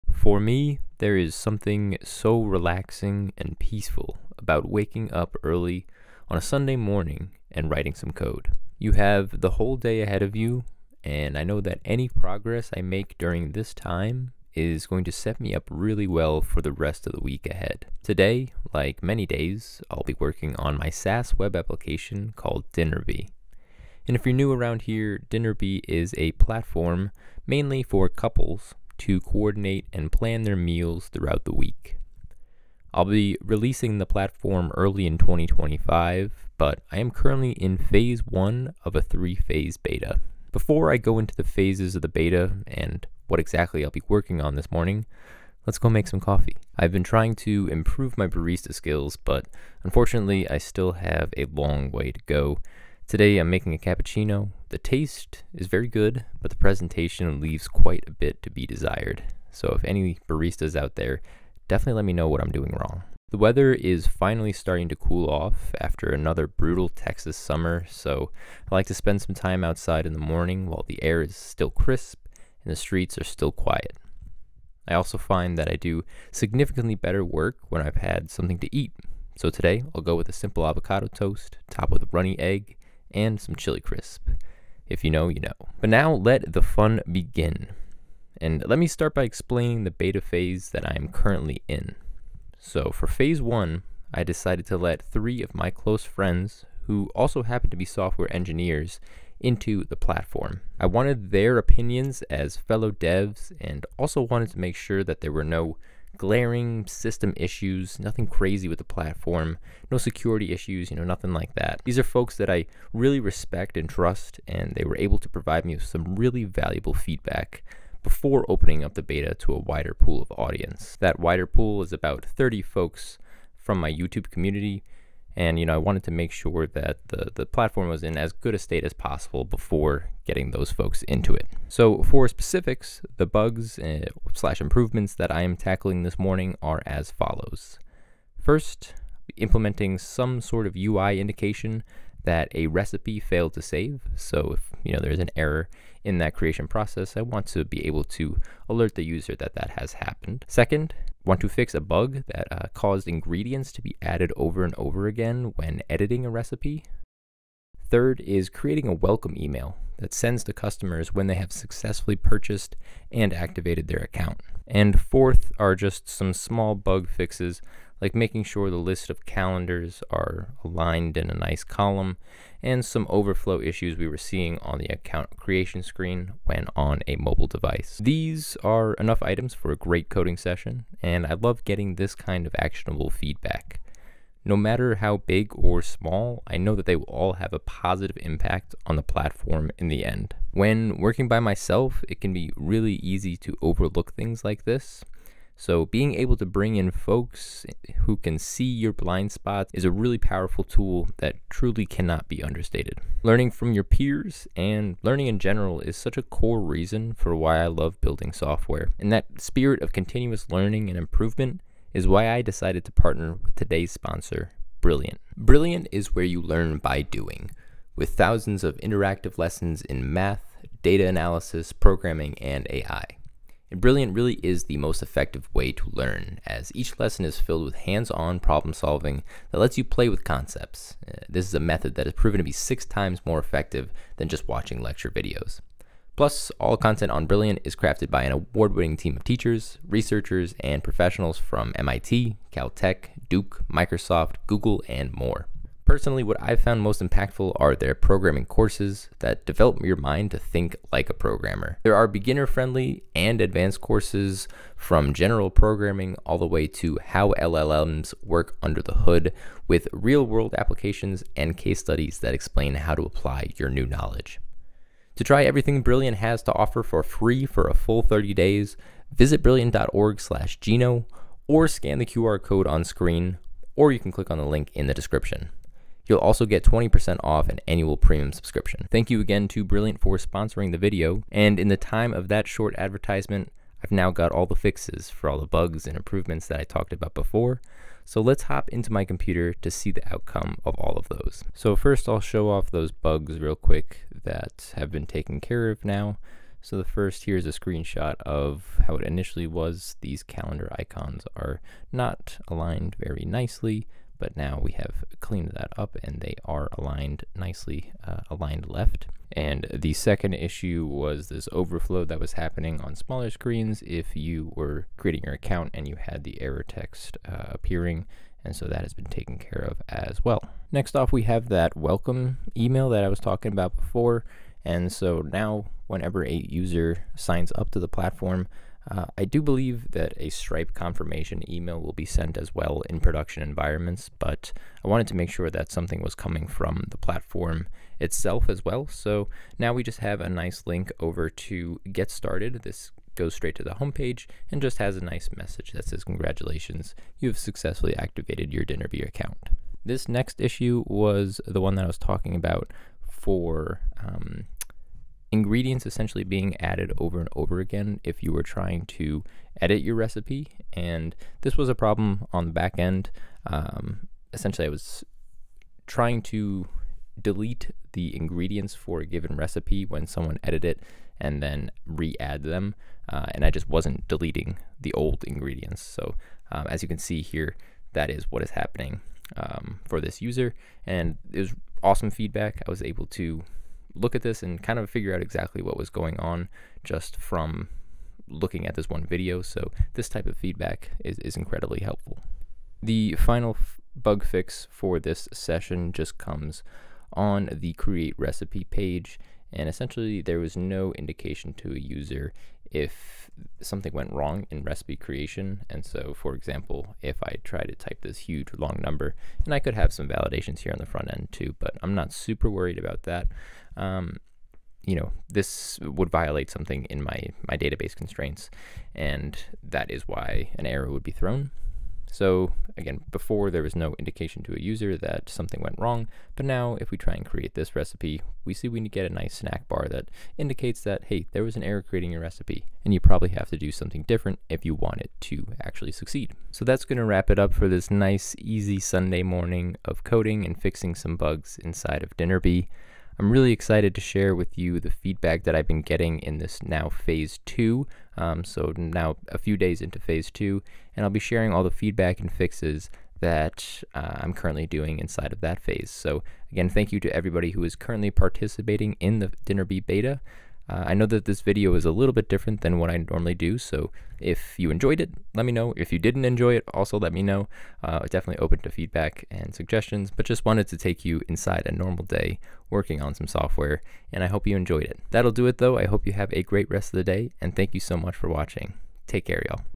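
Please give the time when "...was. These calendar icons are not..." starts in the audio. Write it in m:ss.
4:59.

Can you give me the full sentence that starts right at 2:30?
Second, Want to fix a bug that uh, caused ingredients to be added over and over again when editing a recipe?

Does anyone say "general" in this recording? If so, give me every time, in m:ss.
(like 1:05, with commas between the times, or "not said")
3:25, 4:15.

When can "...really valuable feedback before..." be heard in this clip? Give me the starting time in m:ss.
1:56.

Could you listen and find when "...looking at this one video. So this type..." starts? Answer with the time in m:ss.
6:28.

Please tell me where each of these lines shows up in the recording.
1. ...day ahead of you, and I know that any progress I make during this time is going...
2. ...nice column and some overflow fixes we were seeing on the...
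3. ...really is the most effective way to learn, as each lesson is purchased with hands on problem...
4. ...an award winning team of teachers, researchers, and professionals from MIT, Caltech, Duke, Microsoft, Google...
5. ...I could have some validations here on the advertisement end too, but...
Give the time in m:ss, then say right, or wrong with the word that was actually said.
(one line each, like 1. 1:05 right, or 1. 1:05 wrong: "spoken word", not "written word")
1. 0:09 right
2. 2:51 wrong: "issues", not "fixes"
3. 3:44 wrong: "filled", not "purchased"
4. 3:58 right
5. 6:49 wrong: "front", not "advertisement".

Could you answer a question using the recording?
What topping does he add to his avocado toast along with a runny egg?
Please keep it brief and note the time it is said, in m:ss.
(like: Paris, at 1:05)
Chili crisp, at 1:23.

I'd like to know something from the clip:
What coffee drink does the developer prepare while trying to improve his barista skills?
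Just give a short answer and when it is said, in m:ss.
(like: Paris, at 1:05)
Cappuccino, at 0:53.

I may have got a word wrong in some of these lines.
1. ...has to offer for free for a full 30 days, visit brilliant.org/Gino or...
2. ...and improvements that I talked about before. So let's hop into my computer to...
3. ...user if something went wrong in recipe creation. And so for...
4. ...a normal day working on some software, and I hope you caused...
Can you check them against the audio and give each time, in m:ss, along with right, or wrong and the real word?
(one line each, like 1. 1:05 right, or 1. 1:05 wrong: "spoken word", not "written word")
1. 4:26 right
2. 4:45 right
3. 6:41 right
4. 7:51 wrong: "enjoyed", not "caused".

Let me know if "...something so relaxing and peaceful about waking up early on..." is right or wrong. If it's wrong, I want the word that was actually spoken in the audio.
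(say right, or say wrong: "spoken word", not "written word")
right.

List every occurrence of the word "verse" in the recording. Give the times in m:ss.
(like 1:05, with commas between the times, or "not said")
not said.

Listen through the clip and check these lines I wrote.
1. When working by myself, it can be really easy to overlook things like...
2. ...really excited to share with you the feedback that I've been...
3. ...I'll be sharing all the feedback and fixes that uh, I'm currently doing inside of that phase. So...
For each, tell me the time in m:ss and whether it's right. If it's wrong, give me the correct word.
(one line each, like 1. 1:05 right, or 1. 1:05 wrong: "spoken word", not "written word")
1. 3:10 right
2. 7:23 right
3. 7:31 right.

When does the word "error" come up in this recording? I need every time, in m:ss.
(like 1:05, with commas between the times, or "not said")
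2:25, 5:16, 7:00, 7:11.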